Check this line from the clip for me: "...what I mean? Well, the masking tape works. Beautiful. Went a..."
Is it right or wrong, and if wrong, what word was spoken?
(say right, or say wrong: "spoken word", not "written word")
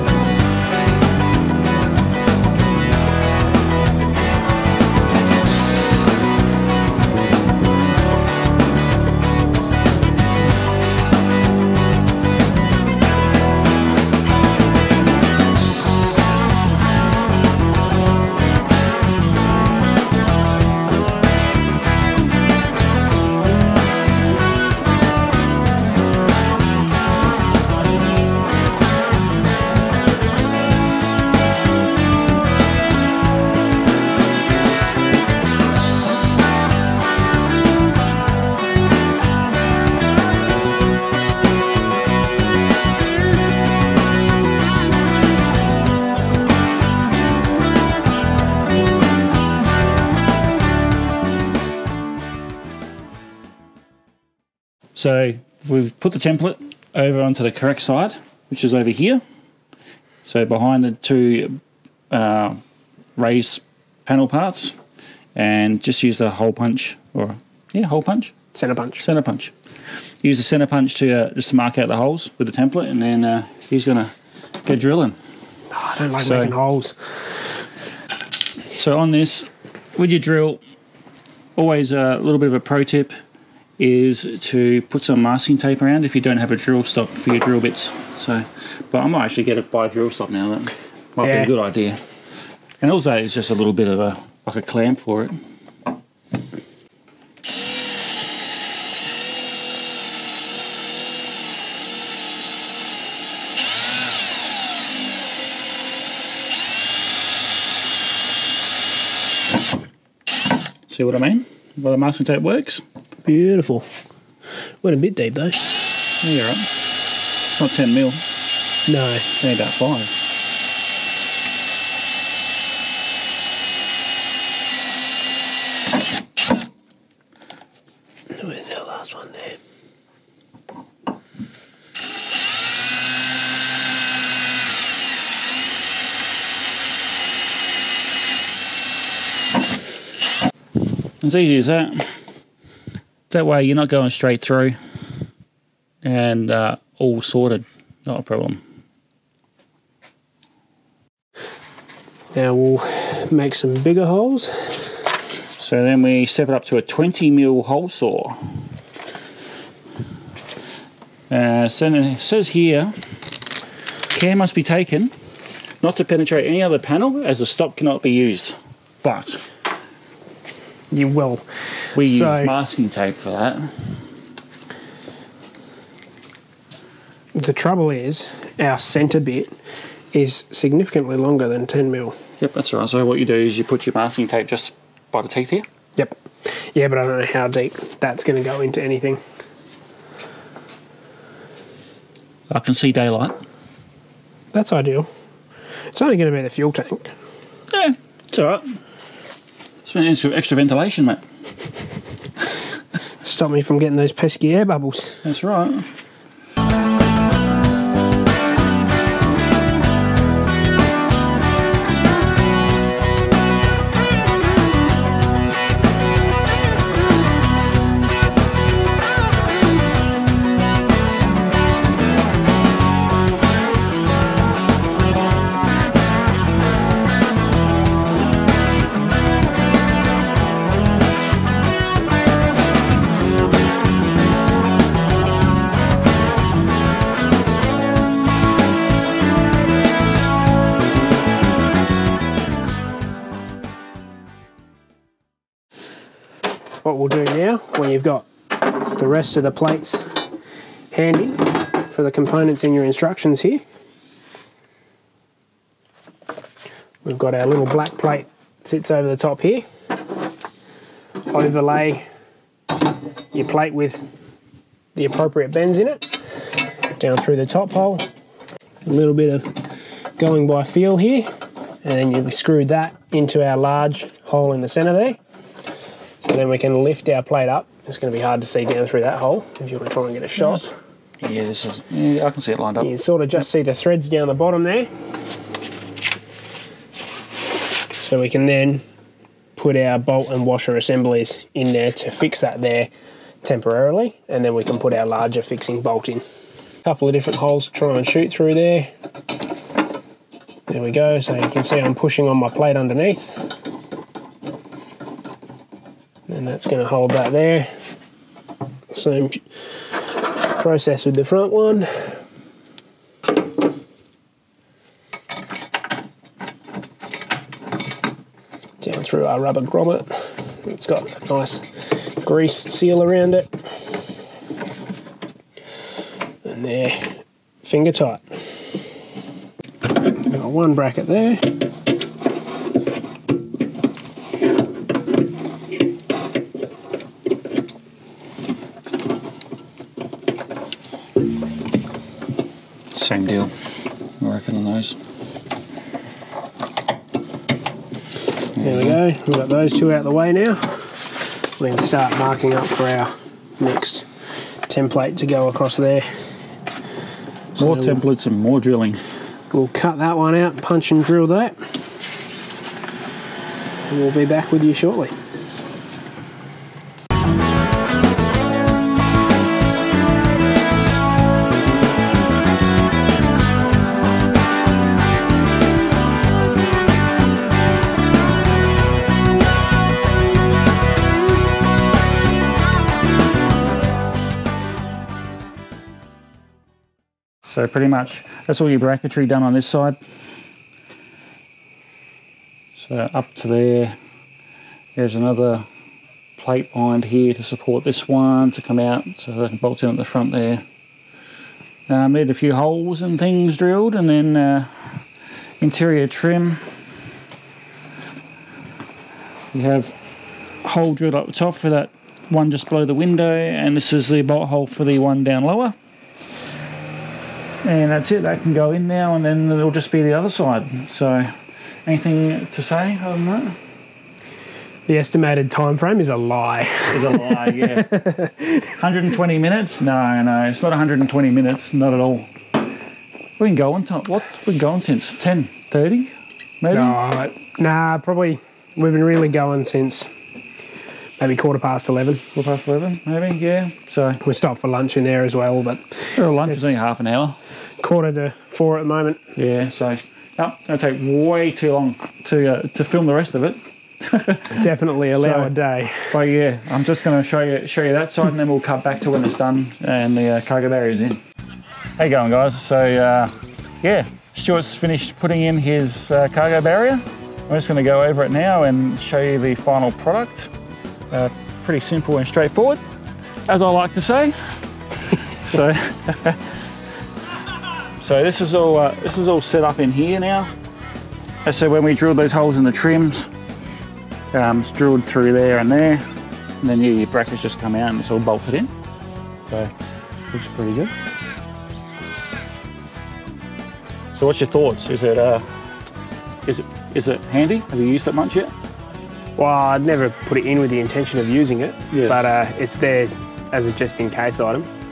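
right.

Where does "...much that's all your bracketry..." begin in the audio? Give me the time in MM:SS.
06:27.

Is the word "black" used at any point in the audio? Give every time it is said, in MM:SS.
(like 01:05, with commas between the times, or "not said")
04:17.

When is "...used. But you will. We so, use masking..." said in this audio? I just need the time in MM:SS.
02:48.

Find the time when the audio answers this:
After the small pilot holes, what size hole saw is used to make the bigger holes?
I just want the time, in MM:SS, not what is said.
02:36.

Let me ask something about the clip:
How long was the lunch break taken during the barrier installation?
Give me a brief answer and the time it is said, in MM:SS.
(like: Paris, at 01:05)
Half an hour, at 07:26.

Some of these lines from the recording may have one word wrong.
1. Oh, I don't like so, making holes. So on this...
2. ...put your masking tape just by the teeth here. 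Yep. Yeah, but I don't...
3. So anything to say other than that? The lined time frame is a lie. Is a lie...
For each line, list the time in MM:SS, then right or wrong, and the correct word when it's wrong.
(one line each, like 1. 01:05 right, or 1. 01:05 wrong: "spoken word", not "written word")
1. 01:15 right
2. 03:03 right
3. 07:00 wrong: "estimated", not "lined".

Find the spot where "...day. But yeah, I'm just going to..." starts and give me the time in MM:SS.
07:35.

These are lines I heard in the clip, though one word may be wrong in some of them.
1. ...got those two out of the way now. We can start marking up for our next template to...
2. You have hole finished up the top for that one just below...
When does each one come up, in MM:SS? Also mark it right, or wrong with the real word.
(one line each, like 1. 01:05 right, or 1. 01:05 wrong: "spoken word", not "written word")
1. 05:49 right
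2. 06:49 wrong: "drilled", not "finished".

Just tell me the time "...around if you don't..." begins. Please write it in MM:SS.
01:25.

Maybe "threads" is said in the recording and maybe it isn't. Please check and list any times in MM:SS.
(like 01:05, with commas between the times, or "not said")
04:43.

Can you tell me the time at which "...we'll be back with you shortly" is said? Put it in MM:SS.
06:03.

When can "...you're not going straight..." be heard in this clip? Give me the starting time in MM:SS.
02:23.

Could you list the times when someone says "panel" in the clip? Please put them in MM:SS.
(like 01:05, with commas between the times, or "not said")
01:04, 02:46.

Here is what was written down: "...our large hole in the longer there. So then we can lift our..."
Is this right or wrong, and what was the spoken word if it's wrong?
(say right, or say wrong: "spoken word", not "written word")
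wrong: "center", not "longer".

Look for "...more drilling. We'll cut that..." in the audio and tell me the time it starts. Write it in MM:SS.
05:58.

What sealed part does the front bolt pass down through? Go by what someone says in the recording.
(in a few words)
Rubber grommet.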